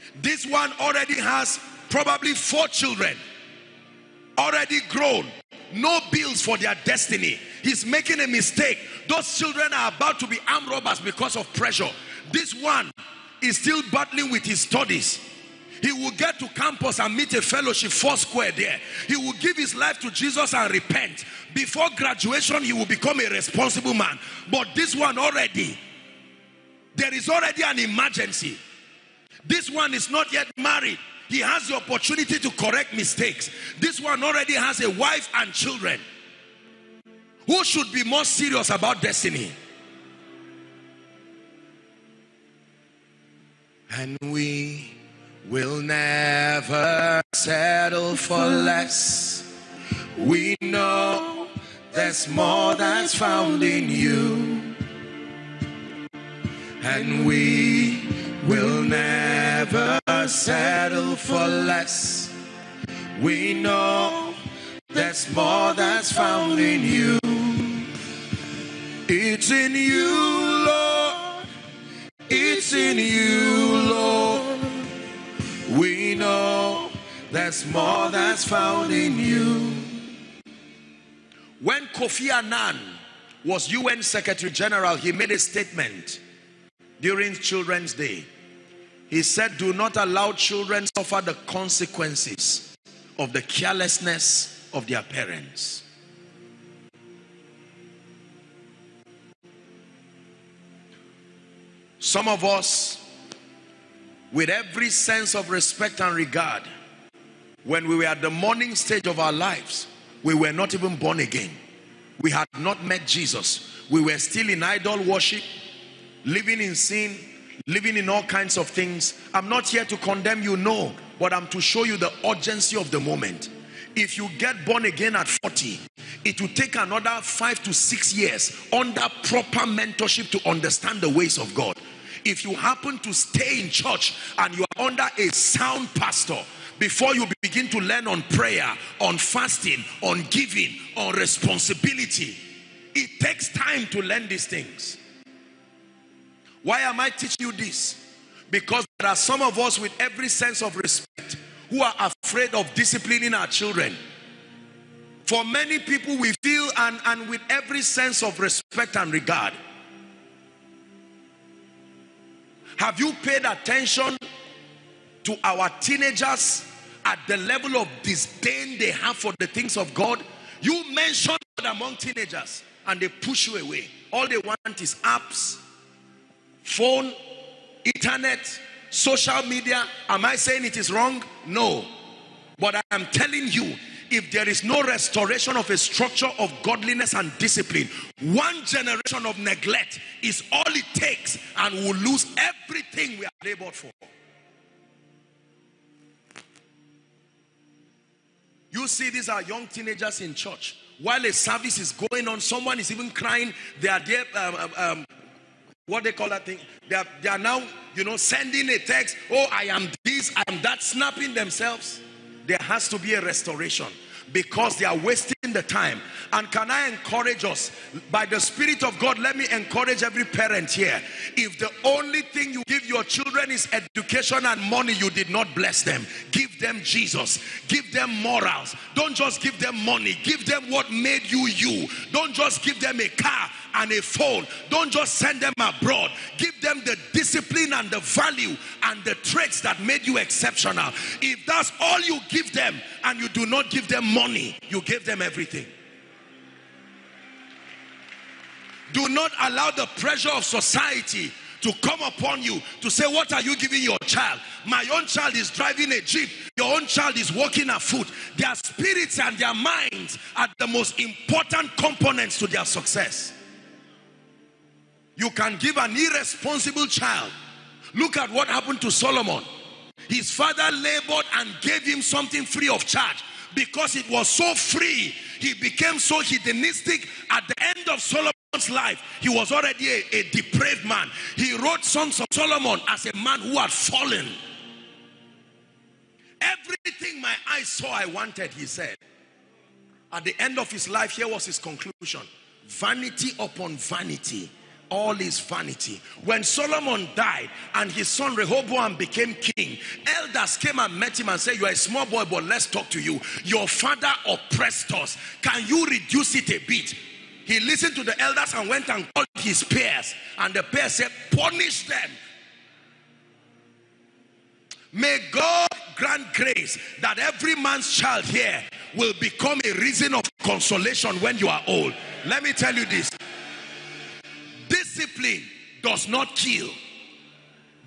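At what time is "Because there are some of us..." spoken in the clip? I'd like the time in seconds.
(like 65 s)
148 s.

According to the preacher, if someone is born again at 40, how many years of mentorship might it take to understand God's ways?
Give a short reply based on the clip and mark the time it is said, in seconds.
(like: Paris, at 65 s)
5 to 6 years, at 127 s.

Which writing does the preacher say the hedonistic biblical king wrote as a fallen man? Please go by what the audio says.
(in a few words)
Songs of Solomon.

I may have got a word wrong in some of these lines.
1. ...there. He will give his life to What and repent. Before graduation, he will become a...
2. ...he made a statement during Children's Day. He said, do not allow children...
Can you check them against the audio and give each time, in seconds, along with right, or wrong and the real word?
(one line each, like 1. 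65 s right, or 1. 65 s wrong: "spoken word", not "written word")
1. 18 s wrong: "Jesus", not "What"
2. 84 s right.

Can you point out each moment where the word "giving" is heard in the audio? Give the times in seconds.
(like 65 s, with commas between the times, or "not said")
140 s, 253 s.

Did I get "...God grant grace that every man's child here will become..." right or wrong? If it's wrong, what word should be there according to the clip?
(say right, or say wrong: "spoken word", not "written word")
right.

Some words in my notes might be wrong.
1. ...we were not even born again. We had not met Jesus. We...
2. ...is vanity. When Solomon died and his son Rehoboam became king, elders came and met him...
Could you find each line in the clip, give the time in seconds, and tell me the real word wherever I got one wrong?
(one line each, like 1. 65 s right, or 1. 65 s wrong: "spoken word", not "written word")
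1. 110 s right
2. 295 s right.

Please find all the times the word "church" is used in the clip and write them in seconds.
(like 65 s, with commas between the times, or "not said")
133 s, 200 s.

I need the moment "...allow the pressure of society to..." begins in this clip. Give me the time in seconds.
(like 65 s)
249 s.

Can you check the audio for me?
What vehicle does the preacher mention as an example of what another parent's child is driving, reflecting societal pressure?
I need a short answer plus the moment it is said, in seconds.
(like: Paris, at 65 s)
Jeep, at 255 s.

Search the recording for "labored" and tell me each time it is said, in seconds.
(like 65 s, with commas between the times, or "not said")
193 s, 270 s.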